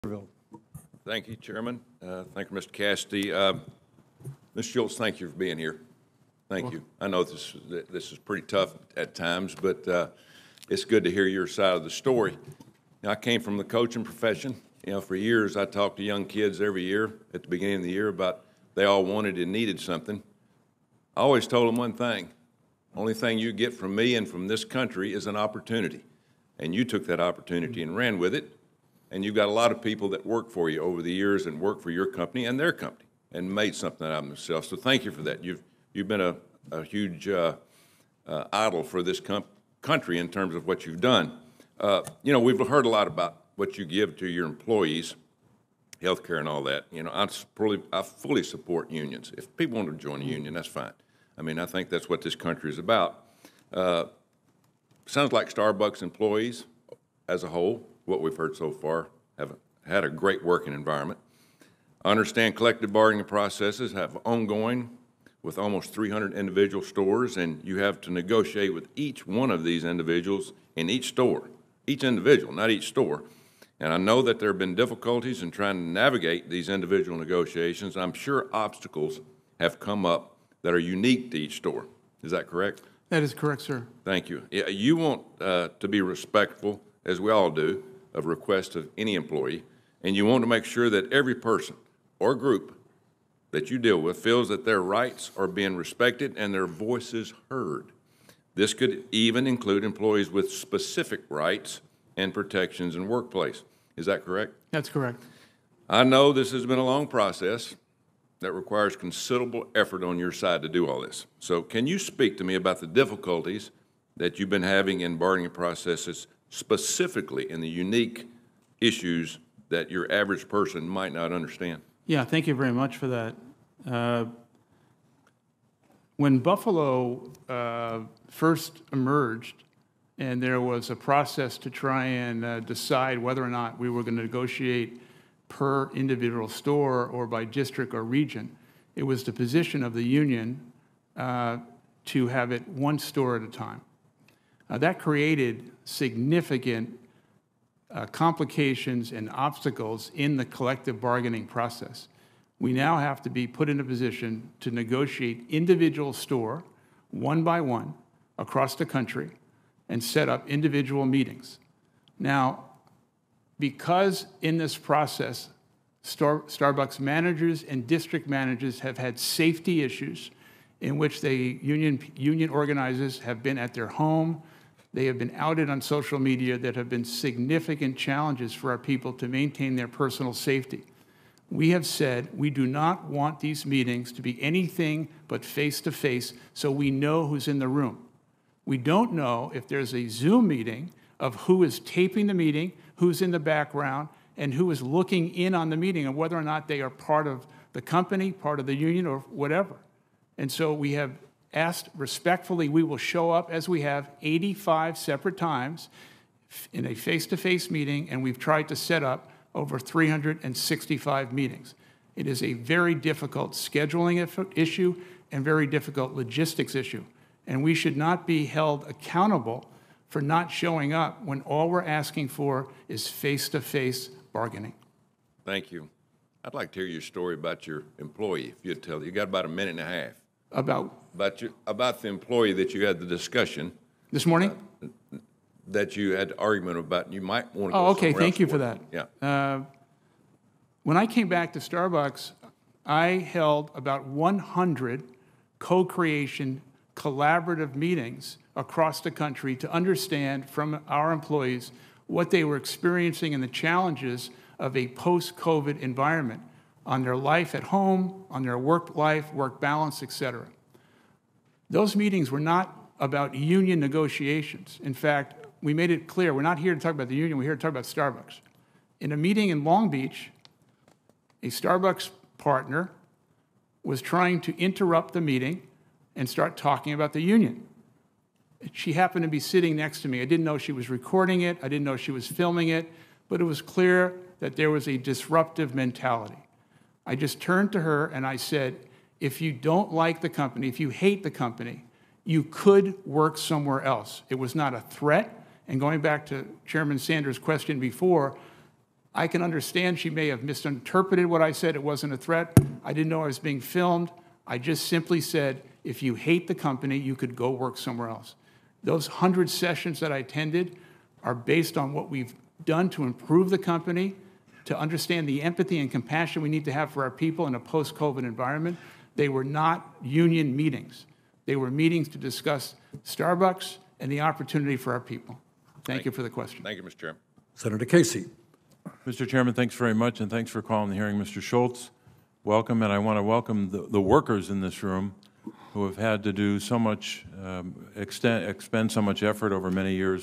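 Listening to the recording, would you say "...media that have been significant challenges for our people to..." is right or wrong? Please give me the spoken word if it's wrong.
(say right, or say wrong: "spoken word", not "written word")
right.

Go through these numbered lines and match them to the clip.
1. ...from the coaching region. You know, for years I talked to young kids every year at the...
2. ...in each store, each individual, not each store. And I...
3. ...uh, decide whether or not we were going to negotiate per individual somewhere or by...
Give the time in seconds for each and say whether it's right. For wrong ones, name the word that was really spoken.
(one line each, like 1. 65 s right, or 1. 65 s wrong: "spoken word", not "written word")
1. 13 s wrong: "profession", not "region"
2. 70 s right
3. 132 s wrong: "store", not "somewhere".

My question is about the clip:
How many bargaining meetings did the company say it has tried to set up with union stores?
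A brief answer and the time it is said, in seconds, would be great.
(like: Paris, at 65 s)
365, at 209 s.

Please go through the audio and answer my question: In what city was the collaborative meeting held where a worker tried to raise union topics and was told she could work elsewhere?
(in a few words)
Long Beach.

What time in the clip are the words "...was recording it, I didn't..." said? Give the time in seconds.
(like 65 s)
280 s.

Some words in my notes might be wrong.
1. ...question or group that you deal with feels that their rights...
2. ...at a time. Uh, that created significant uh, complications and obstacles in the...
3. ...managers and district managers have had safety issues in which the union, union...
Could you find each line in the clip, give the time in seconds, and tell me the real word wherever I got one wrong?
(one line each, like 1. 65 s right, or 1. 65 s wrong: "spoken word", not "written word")
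1. 91 s wrong: "person", not "question"
2. 143 s right
3. 167 s right.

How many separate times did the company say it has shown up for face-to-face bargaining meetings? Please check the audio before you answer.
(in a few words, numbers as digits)
85.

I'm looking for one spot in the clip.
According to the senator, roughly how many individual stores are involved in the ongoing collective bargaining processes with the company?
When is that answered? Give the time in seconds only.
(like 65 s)
65 s.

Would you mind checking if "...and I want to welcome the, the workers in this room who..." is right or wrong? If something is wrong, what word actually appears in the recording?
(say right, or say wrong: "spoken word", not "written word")
right.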